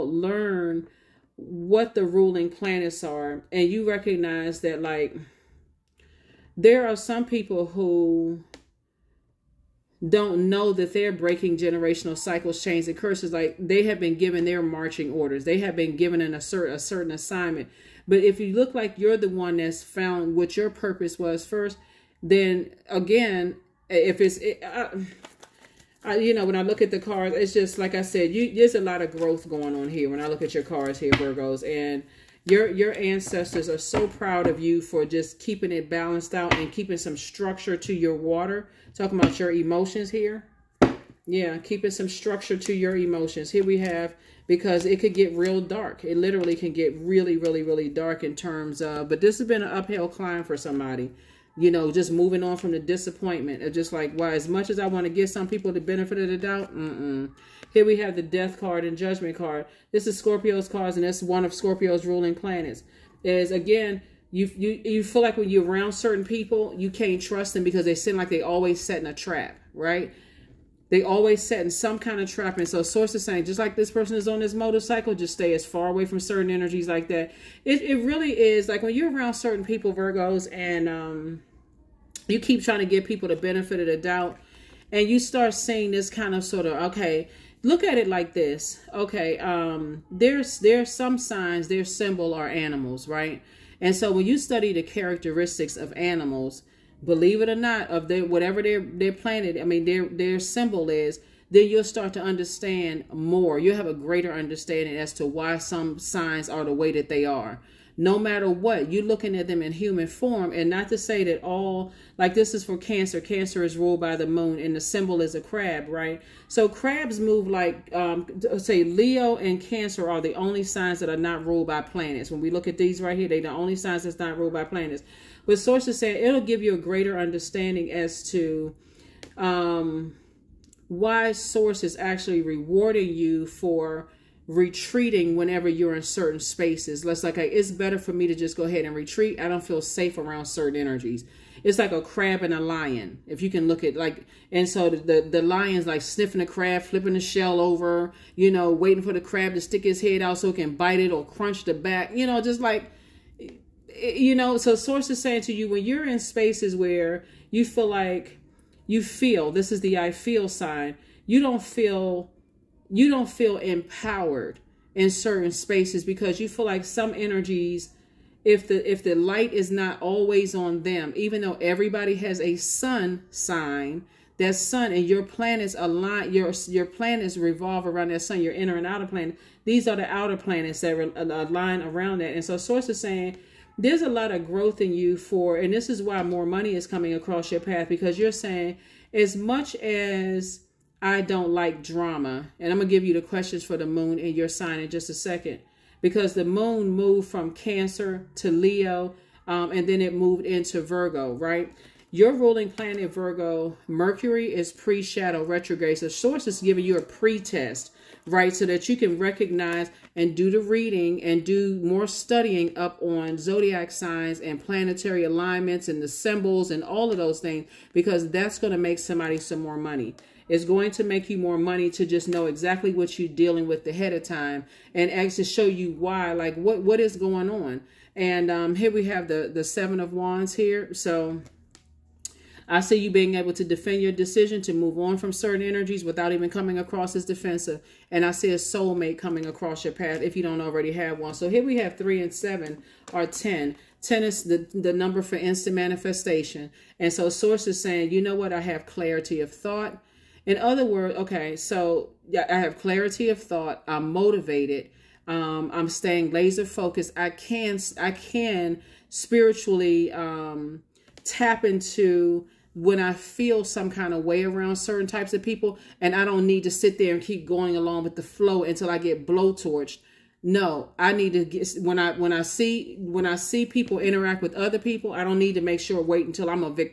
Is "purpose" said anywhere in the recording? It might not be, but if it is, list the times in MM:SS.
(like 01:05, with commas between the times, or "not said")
00:20.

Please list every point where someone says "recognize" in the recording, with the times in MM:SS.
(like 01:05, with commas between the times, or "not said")
00:03, 03:29.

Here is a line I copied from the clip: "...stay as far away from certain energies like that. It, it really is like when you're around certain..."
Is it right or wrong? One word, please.
right.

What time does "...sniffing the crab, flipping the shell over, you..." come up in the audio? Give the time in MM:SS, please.
02:26.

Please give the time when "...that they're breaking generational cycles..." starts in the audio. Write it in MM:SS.
00:10.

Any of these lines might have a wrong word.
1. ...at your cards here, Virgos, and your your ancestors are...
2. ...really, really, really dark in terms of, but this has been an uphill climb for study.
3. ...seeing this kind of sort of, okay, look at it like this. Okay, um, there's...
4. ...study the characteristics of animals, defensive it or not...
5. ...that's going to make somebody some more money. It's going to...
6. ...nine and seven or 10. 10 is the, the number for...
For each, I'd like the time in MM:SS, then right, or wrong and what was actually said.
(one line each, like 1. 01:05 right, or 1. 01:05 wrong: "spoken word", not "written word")
1. 00:30 right
2. 00:46 wrong: "somebody", not "study"
3. 01:25 right
4. 01:34 wrong: "believe", not "defensive"
5. 03:38 right
6. 04:01 wrong: "three", not "nine".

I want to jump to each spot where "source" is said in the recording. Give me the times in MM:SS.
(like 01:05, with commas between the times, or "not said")
01:12, 02:05, 02:11, 02:34, 03:02, 03:26, 04:07.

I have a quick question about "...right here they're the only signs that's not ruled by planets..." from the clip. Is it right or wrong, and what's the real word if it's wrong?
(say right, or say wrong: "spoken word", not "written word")
right.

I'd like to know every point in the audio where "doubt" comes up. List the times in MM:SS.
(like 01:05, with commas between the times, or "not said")
00:56, 01:23.